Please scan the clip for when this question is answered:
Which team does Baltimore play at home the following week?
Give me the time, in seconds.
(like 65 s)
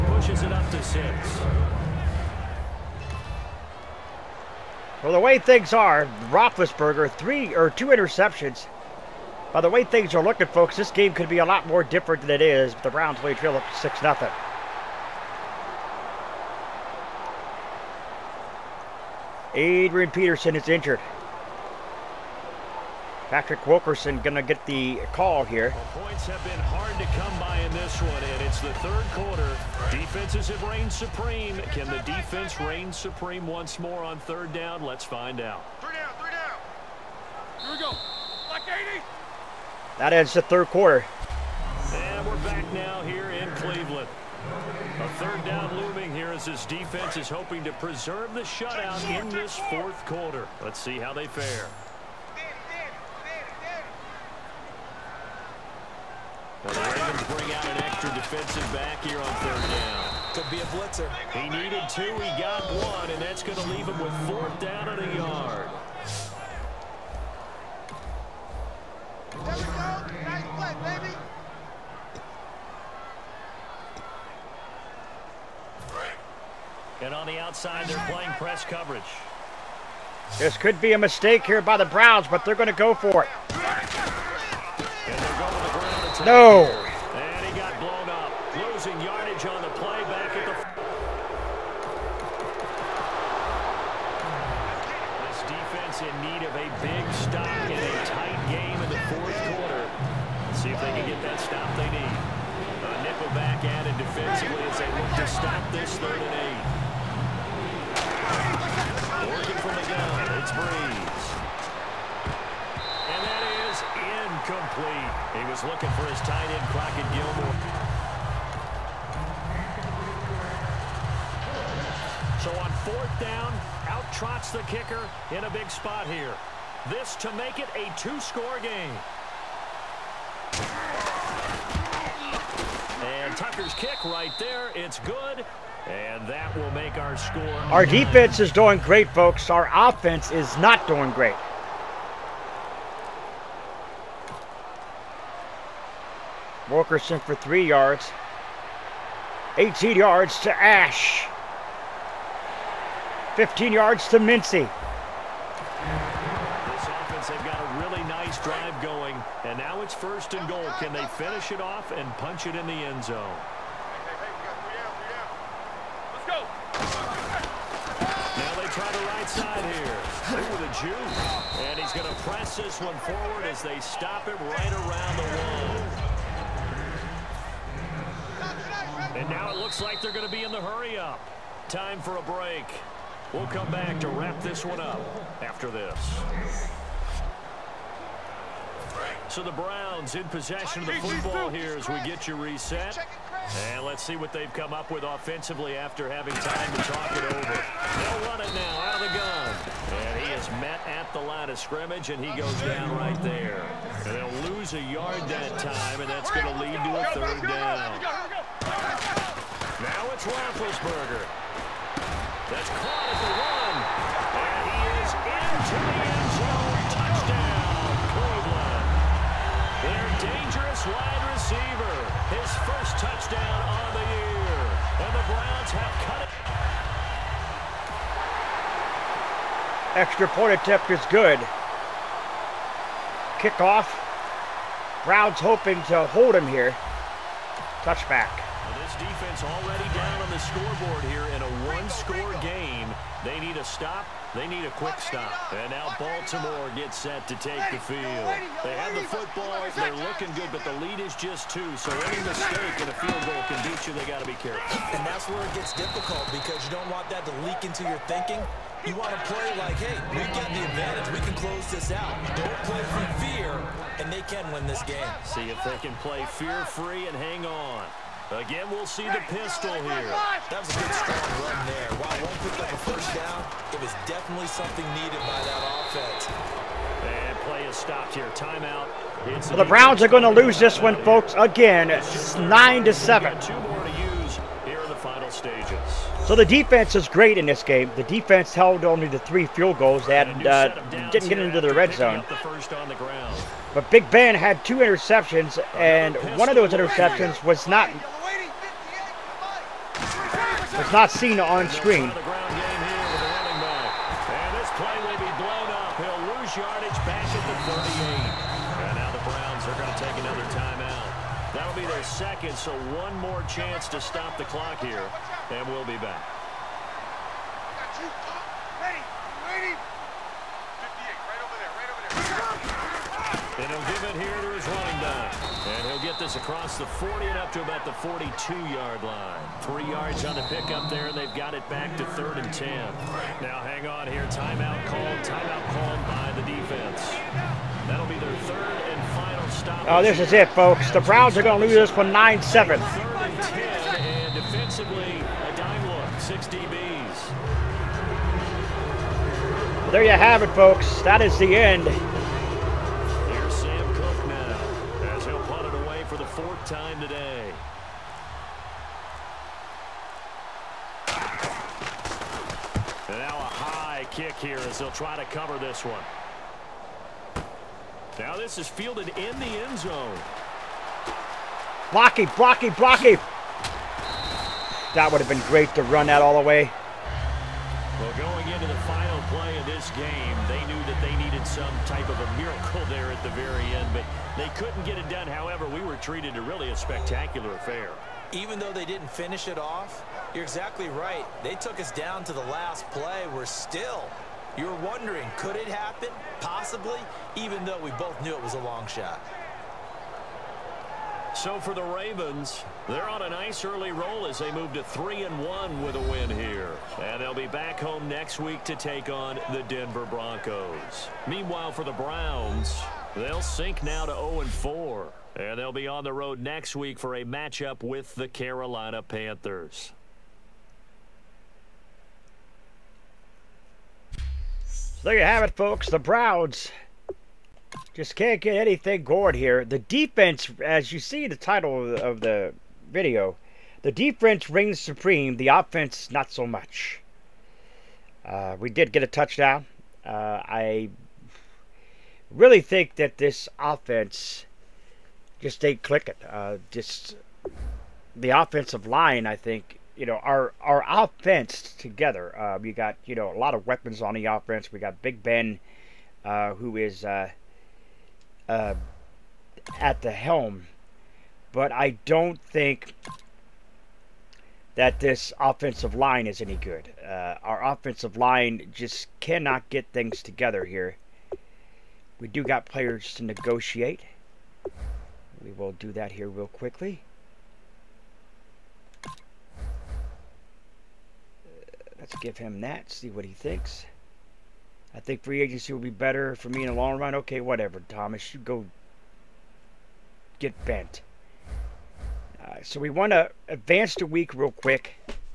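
409 s.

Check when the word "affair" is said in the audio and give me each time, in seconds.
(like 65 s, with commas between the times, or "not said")
387 s.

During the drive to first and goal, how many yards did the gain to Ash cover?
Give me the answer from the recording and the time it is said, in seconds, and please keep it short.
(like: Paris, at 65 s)
18, at 149 s.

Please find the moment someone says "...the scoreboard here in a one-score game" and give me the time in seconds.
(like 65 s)
240 s.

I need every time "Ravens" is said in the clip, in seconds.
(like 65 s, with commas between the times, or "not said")
56 s, 401 s.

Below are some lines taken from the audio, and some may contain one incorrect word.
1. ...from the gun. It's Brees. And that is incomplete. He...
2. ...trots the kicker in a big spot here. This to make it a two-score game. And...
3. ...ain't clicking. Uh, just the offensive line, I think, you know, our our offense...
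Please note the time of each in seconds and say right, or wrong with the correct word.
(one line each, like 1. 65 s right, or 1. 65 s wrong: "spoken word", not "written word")
1. 109 s right
2. 124 s right
3. 445 s right.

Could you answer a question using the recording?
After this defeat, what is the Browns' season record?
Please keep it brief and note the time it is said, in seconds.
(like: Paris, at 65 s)
0-4, at 414 s.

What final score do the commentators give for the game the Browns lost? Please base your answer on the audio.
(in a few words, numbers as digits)
9-7.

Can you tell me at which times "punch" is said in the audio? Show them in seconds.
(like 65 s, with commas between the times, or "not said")
162 s.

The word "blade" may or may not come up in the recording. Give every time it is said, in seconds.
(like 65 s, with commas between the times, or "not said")
not said.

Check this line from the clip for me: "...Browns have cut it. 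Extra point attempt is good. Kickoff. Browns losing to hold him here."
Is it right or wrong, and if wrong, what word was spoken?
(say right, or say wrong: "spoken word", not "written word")
wrong: "hoping", not "losing".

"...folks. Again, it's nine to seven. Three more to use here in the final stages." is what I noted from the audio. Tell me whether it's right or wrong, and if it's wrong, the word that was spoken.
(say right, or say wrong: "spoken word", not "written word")
wrong: "Two", not "Three".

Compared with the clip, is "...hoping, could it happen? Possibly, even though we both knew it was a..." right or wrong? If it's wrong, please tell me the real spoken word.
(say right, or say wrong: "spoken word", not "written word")
wrong: "wondering", not "hoping".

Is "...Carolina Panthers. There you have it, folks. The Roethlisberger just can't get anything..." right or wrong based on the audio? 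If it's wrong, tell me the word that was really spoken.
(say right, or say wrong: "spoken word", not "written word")
wrong: "Browns", not "Roethlisberger".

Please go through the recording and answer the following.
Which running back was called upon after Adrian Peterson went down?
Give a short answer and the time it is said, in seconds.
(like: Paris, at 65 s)
Patrick Wilkerson, at 23 s.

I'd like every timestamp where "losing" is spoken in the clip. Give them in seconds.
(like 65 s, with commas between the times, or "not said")
88 s.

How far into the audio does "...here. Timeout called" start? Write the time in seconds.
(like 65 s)
334 s.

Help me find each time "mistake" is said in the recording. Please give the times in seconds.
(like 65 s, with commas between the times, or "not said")
80 s, 252 s.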